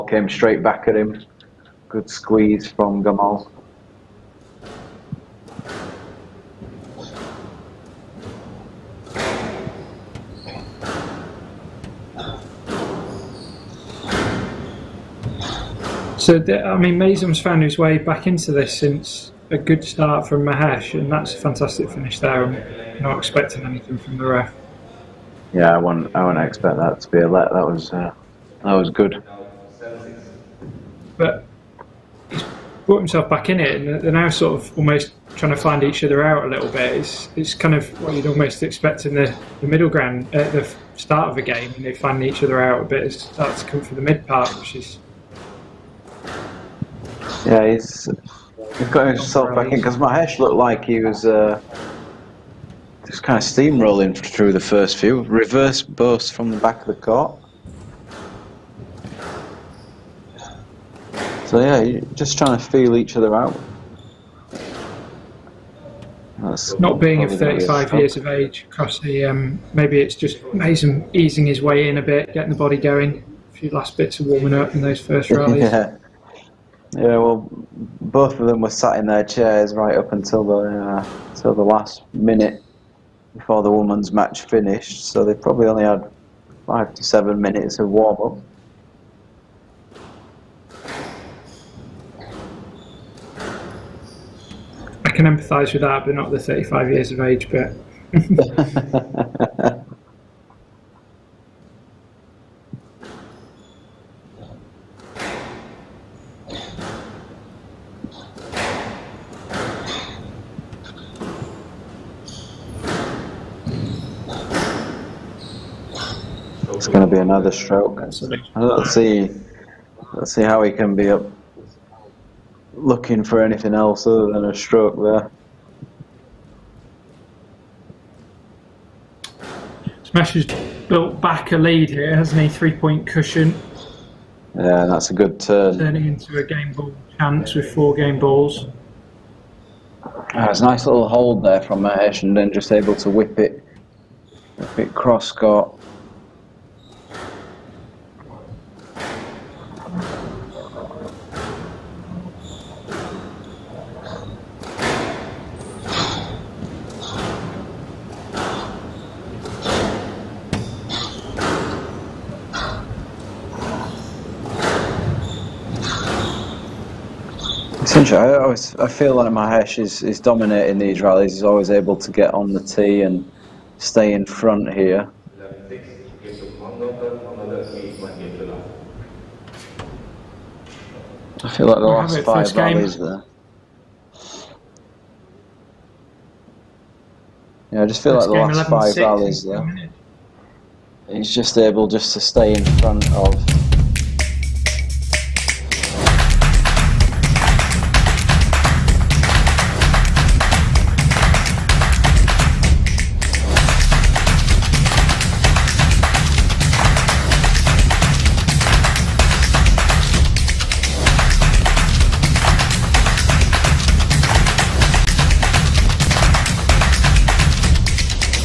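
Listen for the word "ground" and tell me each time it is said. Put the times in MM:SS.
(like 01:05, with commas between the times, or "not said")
00:39.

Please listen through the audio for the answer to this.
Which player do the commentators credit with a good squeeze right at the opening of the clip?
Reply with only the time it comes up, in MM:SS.
00:03.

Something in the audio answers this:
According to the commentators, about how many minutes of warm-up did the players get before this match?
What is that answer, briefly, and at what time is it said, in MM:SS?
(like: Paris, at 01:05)
5 to 7 minutes, at 01:26.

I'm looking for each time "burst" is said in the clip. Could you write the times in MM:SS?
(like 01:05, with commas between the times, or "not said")
00:55.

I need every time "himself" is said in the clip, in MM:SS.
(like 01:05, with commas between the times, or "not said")
00:32, 00:49.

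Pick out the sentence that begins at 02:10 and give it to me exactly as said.
Smash has built back a lead here, hasn't he?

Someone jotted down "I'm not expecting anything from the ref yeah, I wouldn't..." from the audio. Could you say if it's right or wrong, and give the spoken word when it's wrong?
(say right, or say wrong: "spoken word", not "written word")
right.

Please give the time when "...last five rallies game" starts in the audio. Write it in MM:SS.
03:01.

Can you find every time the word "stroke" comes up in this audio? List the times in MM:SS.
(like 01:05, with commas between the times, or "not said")
01:57, 02:04.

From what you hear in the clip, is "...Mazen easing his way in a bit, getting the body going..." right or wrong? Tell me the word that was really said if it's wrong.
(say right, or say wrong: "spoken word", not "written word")
right.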